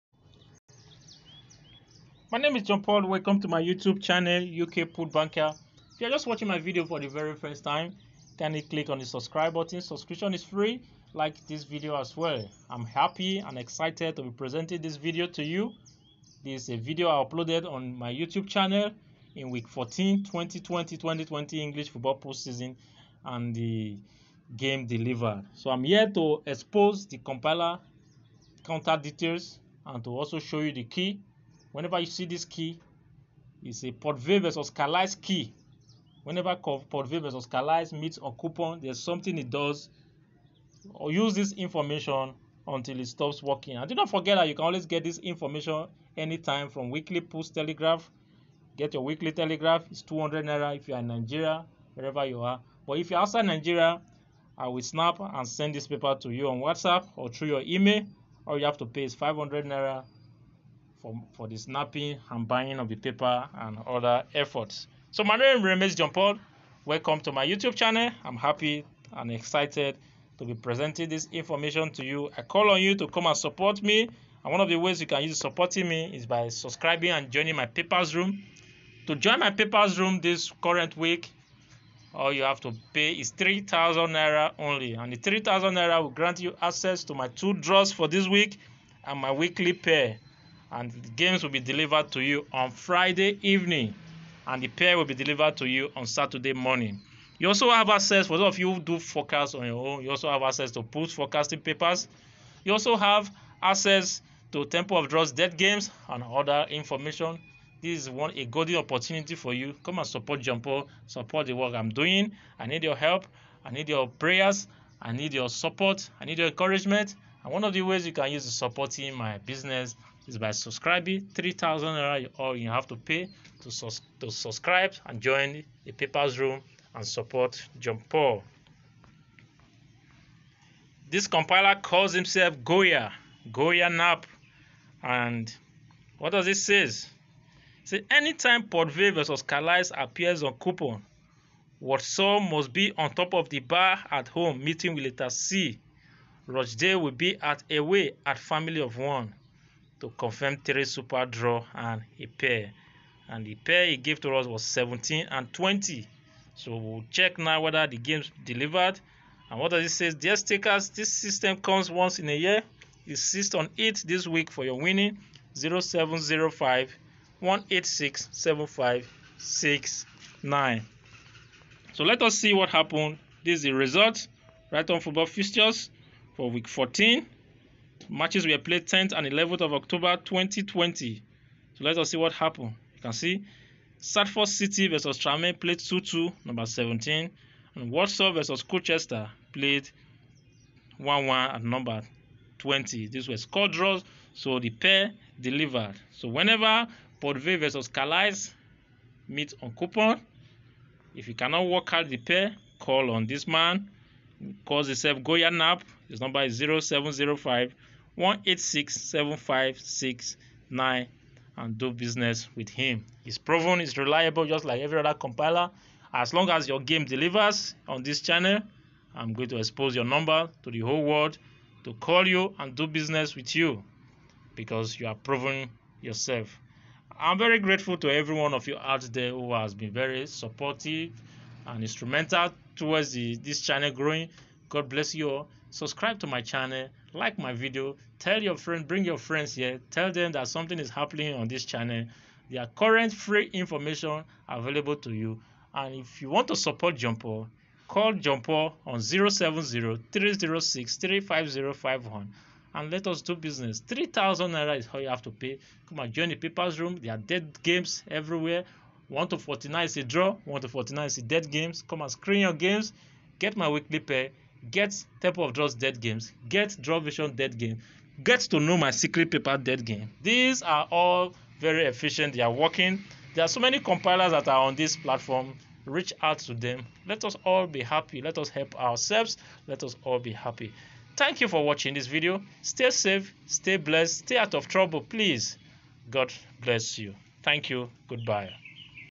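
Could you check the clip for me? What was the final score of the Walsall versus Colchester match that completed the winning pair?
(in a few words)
1-1.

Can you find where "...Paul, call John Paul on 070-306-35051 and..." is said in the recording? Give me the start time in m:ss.
4:07.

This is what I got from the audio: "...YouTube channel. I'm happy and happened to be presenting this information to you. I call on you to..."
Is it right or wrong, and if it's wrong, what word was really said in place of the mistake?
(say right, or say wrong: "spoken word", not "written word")
wrong: "excited", not "happened".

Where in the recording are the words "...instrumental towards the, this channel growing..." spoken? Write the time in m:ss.
3:51.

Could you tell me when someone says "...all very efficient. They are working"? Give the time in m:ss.
4:30.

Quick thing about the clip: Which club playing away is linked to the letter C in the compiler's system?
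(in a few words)
Rochdale.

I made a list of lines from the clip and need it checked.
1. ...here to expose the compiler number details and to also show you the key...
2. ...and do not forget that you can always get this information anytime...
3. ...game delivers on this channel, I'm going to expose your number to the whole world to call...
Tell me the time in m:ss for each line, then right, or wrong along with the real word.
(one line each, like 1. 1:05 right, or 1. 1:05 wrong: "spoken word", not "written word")
1. 0:25 wrong: "counter", not "number"
2. 0:43 right
3. 3:36 right.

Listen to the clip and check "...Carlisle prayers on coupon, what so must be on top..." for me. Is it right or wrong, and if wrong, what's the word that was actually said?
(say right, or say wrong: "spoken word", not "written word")
wrong: "appears", not "prayers".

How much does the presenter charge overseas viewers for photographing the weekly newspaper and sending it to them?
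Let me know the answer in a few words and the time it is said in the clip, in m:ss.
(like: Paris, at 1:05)
500 naira, at 0:59.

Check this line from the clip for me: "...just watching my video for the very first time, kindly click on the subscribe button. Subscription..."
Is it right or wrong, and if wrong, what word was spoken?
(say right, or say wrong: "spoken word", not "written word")
right.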